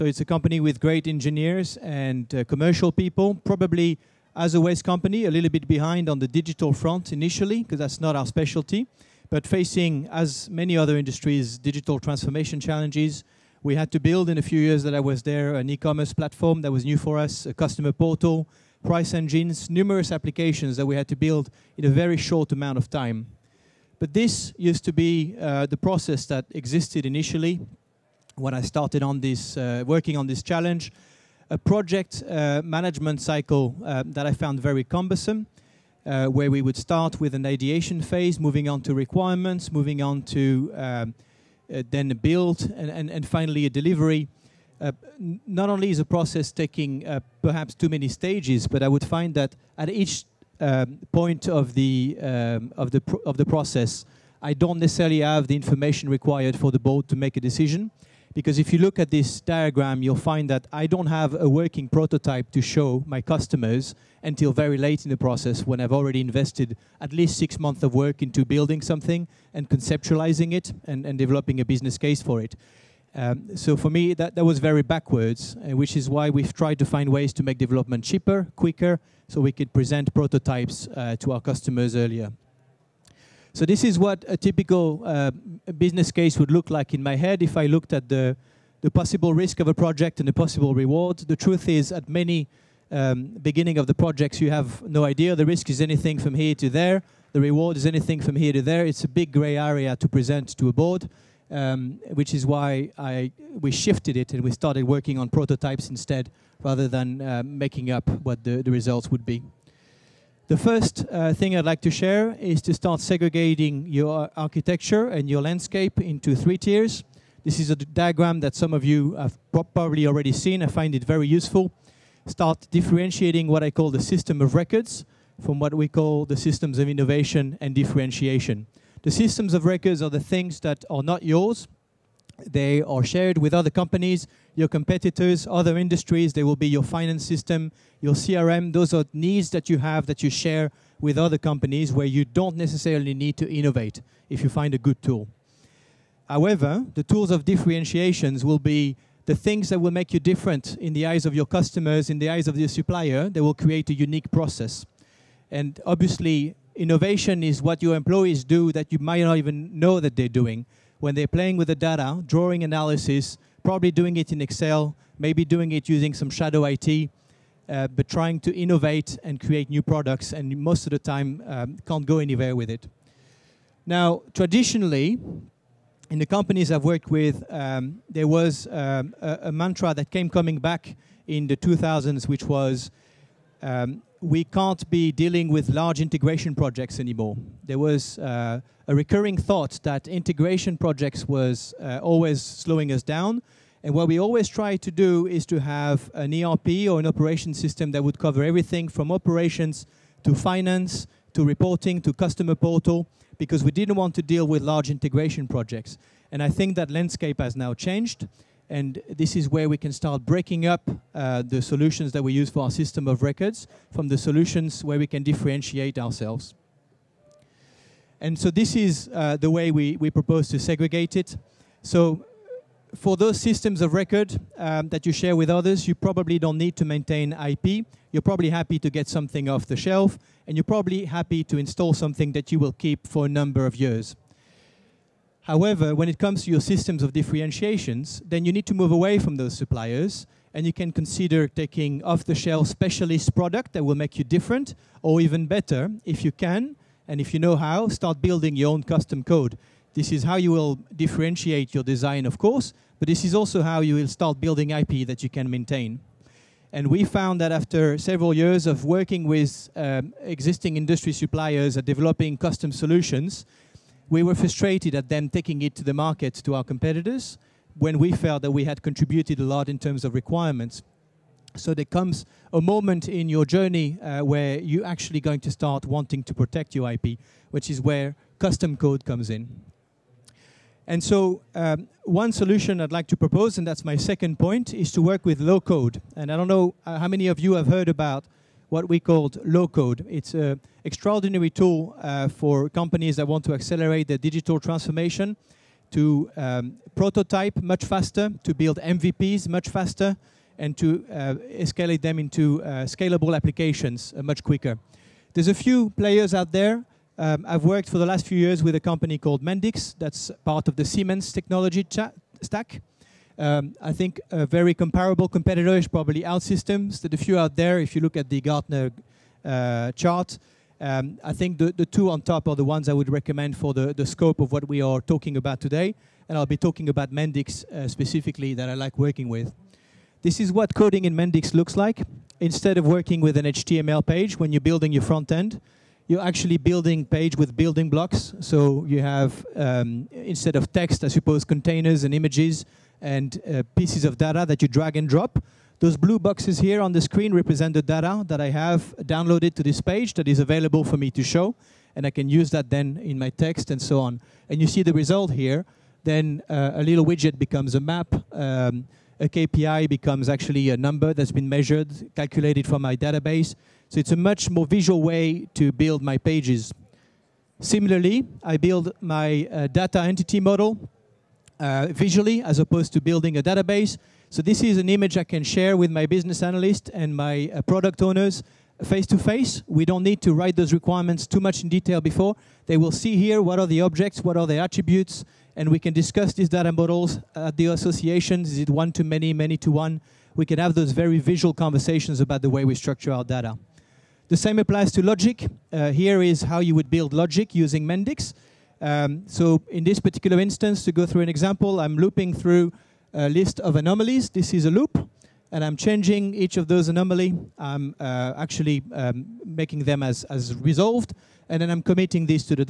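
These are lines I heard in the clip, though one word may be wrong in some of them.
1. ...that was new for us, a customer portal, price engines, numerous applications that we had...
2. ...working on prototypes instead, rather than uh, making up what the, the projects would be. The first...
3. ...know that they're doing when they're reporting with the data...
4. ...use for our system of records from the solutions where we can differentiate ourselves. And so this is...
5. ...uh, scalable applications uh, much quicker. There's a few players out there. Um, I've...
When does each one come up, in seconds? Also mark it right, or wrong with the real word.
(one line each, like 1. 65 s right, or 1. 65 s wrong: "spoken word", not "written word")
1. 16 s right
2. 104 s wrong: "results", not "projects"
3. 159 s wrong: "playing", not "reporting"
4. 212 s right
5. 302 s right.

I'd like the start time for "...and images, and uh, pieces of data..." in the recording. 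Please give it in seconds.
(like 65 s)
342 s.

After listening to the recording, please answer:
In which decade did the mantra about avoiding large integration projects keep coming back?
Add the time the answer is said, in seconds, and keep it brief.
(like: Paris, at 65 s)
2000s, at 181 s.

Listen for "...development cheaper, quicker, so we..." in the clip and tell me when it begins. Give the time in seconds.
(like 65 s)
77 s.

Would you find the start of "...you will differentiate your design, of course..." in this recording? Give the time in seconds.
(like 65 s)
250 s.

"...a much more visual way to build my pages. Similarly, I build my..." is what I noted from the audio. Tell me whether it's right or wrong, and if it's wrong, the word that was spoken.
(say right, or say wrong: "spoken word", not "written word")
right.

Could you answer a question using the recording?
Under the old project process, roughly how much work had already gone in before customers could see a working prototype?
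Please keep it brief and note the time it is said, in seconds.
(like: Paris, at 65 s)
6 months, at 67 s.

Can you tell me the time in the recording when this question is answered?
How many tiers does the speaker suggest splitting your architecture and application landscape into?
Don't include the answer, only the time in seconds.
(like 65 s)
116 s.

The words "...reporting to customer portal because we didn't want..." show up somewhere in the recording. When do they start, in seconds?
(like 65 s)
201 s.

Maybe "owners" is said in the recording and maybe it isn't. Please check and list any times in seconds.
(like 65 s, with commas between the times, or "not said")
378 s.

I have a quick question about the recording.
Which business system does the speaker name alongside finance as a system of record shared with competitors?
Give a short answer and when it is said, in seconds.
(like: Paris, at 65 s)
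CRM, at 138 s.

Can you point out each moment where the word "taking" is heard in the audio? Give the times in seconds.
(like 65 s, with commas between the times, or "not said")
46 s, 241 s, 265 s.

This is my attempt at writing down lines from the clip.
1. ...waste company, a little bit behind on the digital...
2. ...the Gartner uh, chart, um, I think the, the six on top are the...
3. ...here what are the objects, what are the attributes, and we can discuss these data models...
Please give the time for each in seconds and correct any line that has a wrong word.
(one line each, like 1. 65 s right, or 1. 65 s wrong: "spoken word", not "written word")
1. 4 s right
2. 318 s wrong: "two", not "six"
3. 383 s right.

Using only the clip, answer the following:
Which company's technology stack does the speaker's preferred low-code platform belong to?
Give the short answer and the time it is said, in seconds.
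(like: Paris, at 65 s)
Siemens, at 310 s.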